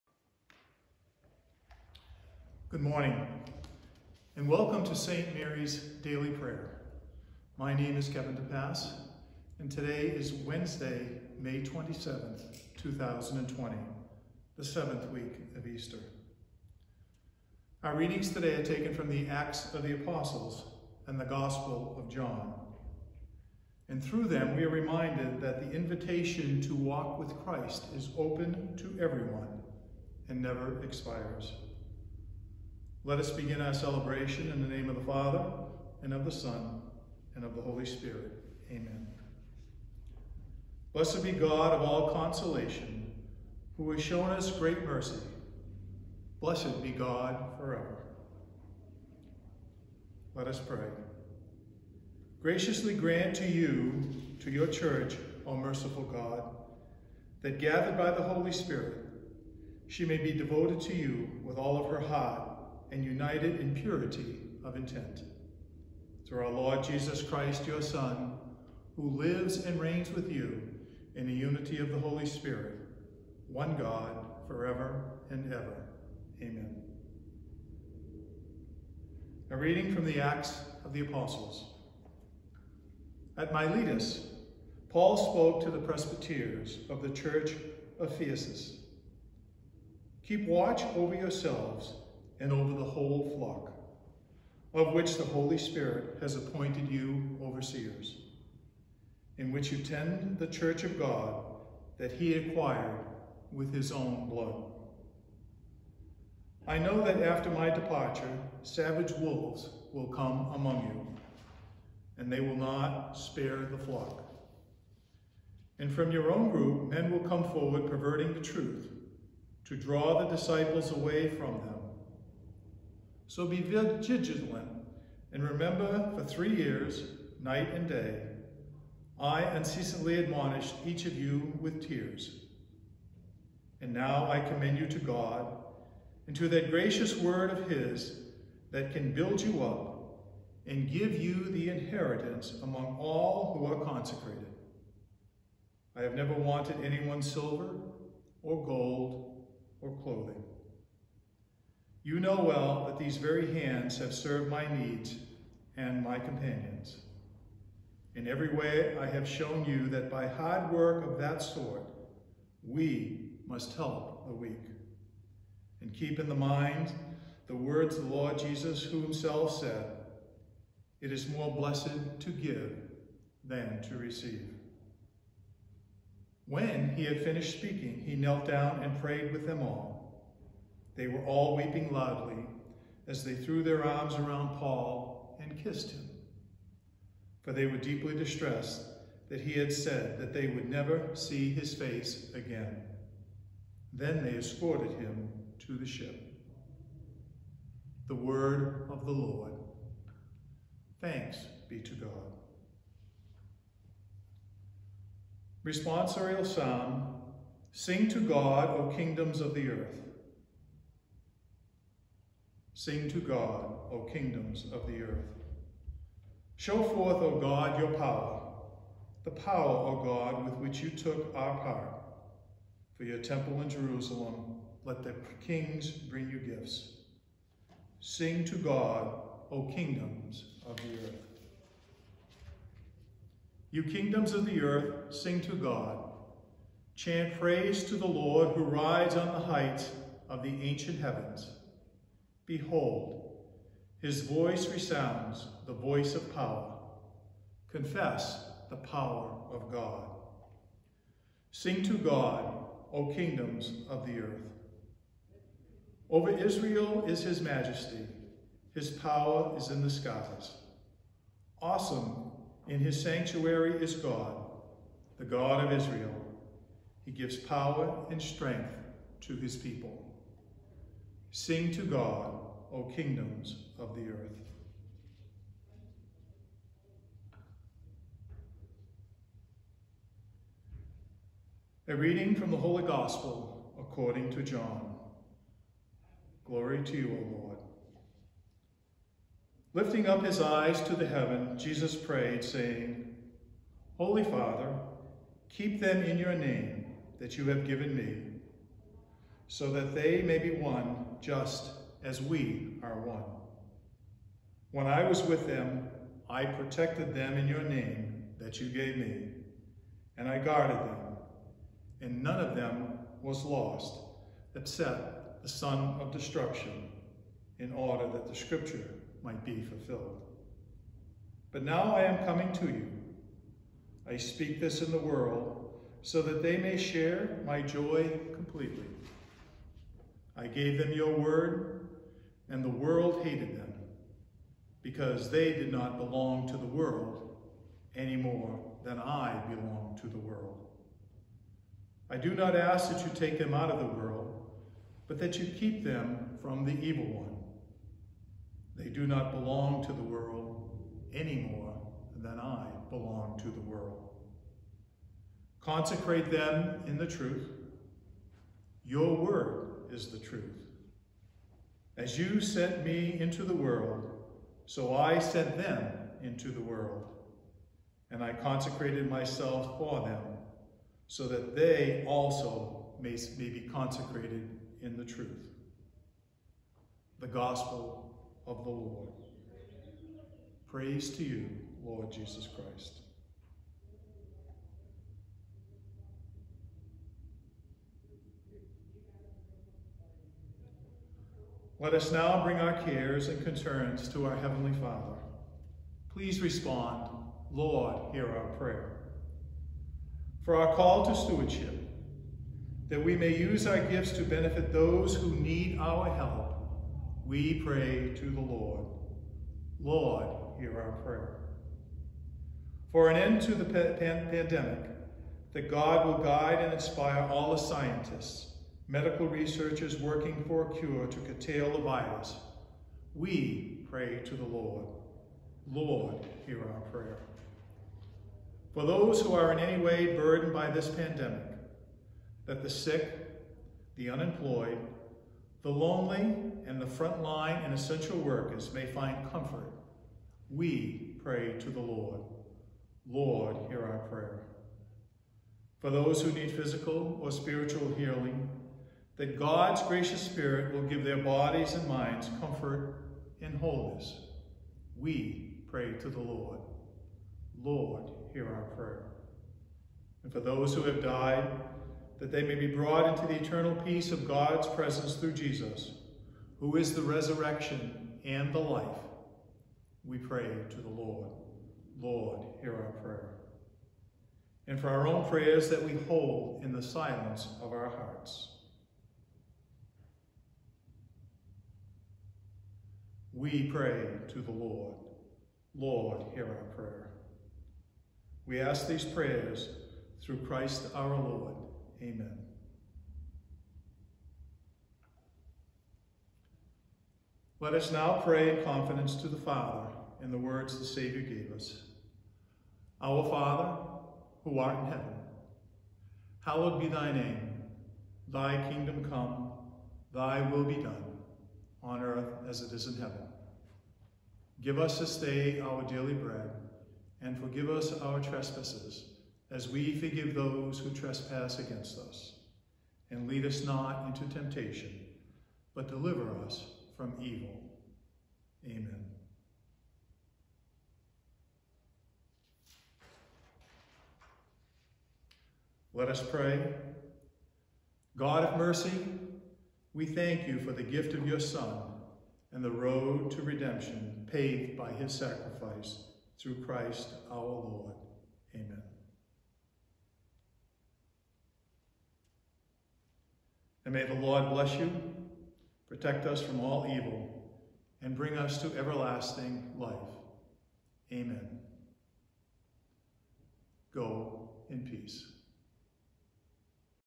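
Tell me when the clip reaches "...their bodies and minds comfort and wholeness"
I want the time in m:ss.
7:31.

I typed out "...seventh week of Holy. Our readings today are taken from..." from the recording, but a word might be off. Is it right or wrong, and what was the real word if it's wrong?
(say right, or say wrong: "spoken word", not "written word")
wrong: "Easter", not "Holy".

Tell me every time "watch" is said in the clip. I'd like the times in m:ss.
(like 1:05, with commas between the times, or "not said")
1:30.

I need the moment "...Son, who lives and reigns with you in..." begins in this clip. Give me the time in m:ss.
1:07.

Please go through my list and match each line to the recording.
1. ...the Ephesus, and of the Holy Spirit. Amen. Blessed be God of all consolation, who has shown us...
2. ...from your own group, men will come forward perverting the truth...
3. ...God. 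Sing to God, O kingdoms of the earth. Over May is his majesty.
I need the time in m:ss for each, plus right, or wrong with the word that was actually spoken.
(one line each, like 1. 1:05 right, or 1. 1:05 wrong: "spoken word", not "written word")
1. 0:36 wrong: "Son", not "Ephesus"
2. 1:55 right
3. 4:09 wrong: "Israel", not "May".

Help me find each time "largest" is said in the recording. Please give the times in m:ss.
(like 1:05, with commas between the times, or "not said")
not said.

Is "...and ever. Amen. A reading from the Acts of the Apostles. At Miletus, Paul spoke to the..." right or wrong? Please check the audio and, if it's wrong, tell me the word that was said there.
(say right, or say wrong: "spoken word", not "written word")
right.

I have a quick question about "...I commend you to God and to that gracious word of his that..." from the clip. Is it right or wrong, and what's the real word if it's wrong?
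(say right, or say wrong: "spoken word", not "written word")
right.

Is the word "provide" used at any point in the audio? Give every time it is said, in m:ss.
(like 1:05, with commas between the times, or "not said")
not said.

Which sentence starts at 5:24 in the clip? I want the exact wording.
I speak this in the world, so that they may share my joy completely.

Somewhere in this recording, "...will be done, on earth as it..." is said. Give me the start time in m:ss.
8:30.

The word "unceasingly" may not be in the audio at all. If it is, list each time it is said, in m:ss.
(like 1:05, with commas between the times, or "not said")
2:09.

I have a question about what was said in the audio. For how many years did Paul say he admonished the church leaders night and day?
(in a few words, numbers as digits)
3.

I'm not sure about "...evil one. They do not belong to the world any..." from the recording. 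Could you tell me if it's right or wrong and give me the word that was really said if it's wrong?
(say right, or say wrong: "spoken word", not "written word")
right.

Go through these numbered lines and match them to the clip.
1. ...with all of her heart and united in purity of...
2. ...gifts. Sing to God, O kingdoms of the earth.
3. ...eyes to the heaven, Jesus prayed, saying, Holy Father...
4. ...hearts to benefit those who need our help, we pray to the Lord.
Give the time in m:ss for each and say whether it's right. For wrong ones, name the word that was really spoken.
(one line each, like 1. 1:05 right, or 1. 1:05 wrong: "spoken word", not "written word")
1. 1:01 right
2. 3:46 right
3. 4:50 right
4. 6:43 wrong: "gifts", not "hearts".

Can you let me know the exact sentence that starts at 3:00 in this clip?
They were all weeping loudly as they threw their arms around Paul and kissed him.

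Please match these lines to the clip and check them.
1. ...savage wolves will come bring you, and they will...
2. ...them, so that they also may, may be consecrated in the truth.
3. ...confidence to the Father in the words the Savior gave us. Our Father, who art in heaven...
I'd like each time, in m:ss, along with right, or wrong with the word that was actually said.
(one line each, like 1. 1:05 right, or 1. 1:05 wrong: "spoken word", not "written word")
1. 1:48 wrong: "among", not "bring"
2. 6:10 right
3. 8:18 right.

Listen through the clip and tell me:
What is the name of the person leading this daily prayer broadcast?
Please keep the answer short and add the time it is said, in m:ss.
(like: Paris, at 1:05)
Kevin DePass, at 0:08.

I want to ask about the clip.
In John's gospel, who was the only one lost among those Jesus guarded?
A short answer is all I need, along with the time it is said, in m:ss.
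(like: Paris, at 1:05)
The son of destruction, at 5:15.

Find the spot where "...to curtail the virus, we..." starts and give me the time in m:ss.
7:01.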